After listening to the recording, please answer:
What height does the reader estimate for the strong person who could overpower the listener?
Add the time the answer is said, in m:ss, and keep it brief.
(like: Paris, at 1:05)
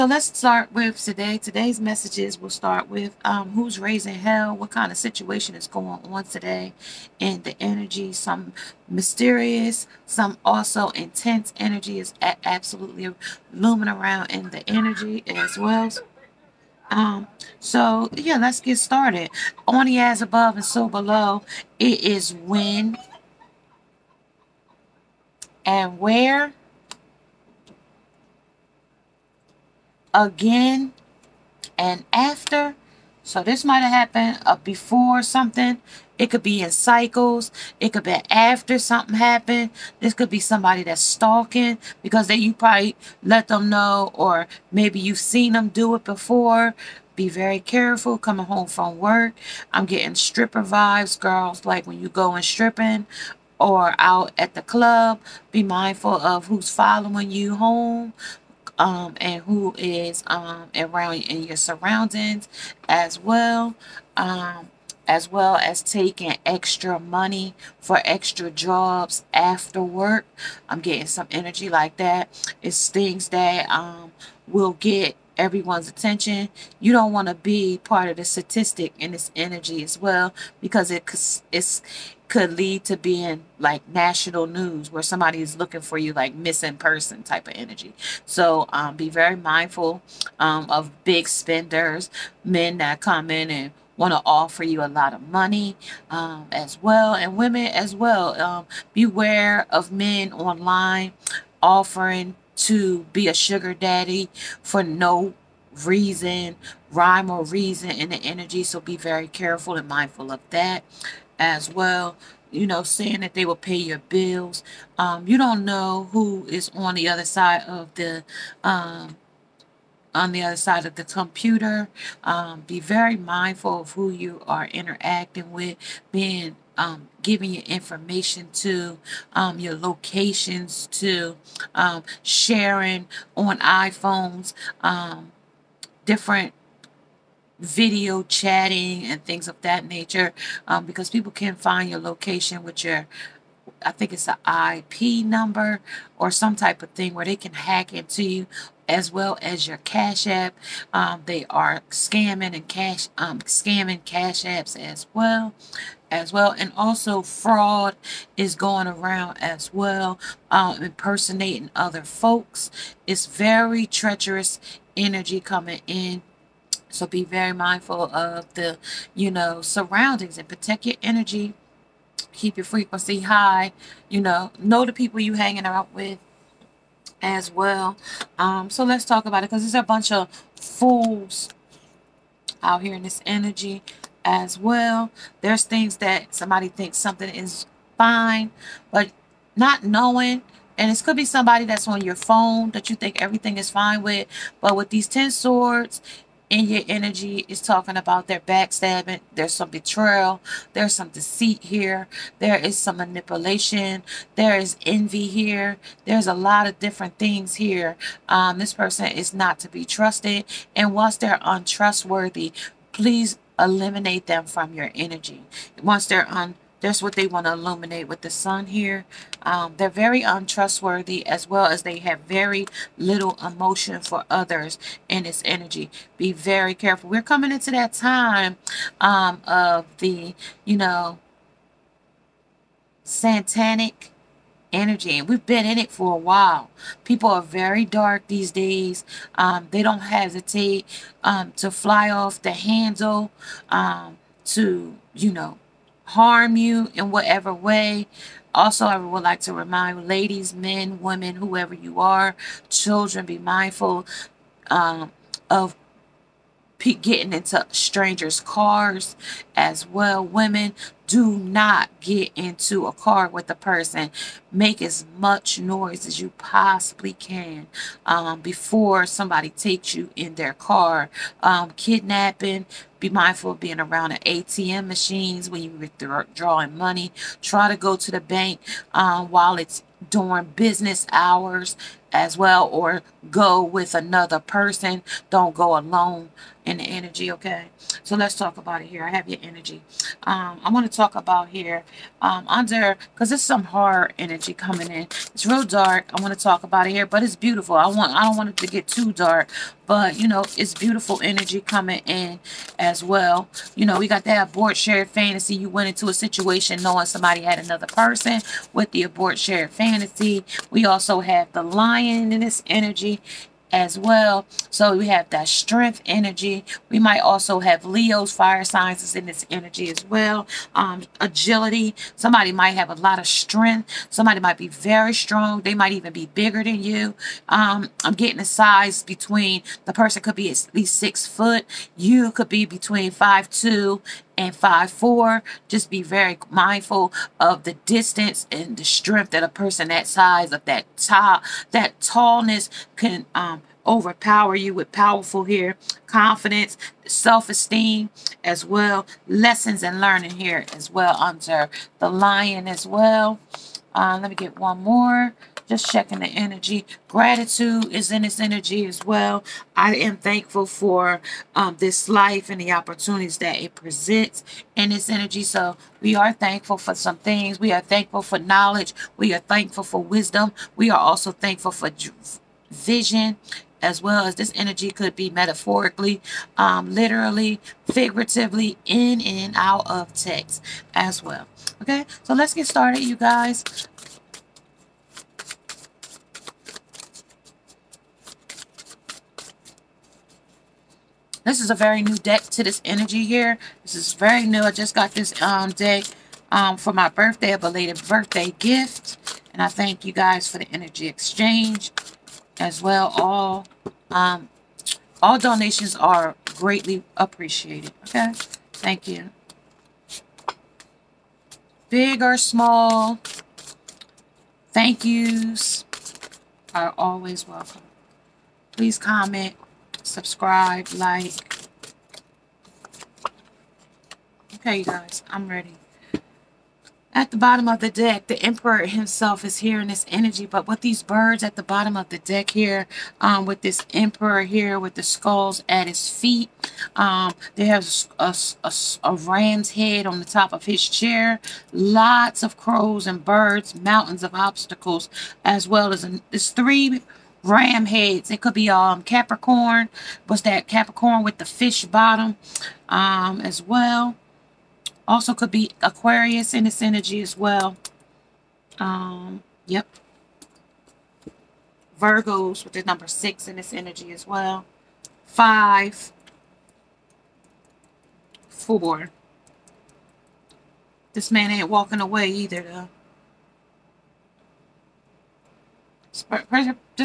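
six foot, at 5:30.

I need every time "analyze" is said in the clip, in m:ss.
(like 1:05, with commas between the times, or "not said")
not said.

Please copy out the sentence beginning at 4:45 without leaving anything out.
Don't go alone in the energy, okay?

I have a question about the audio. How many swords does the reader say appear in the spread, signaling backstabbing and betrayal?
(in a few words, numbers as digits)
10.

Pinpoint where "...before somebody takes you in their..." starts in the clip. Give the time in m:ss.
4:28.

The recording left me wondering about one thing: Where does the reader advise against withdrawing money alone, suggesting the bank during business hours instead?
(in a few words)
ATM machines.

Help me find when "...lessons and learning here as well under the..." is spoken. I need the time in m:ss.
5:49.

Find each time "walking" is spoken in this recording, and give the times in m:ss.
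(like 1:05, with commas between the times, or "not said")
7:51.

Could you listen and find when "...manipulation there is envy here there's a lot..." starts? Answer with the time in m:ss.
3:22.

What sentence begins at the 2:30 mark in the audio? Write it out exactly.
Um, they are scamming and cash um, scamming Cash Apps as well as well.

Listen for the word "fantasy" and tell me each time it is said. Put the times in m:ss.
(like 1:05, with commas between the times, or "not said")
5:05, 5:09.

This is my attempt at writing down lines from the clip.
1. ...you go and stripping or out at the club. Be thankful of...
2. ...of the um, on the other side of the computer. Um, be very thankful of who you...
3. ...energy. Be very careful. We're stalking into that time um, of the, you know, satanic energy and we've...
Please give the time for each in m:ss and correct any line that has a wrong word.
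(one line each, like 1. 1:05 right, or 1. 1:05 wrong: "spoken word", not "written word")
1. 0:51 wrong: "mindful", not "thankful"
2. 1:57 wrong: "mindful", not "thankful"
3. 3:45 wrong: "coming", not "stalking".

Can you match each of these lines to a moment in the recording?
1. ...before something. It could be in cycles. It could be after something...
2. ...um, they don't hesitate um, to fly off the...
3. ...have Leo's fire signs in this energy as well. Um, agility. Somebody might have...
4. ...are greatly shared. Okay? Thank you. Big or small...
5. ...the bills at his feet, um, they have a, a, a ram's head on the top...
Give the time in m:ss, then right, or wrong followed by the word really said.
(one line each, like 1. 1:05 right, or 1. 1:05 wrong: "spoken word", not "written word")
1. 0:34 right
2. 3:59 right
3. 5:17 right
4. 6:45 wrong: "appreciated", not "shared"
5. 7:14 wrong: "skulls", not "bills".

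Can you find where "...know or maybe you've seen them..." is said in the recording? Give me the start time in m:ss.
0:43.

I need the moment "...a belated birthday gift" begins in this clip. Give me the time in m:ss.
6:37.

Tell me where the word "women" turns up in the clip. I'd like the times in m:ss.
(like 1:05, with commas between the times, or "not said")
1:37, 4:11, 4:20.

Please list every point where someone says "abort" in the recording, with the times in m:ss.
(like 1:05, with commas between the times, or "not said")
5:04, 5:09.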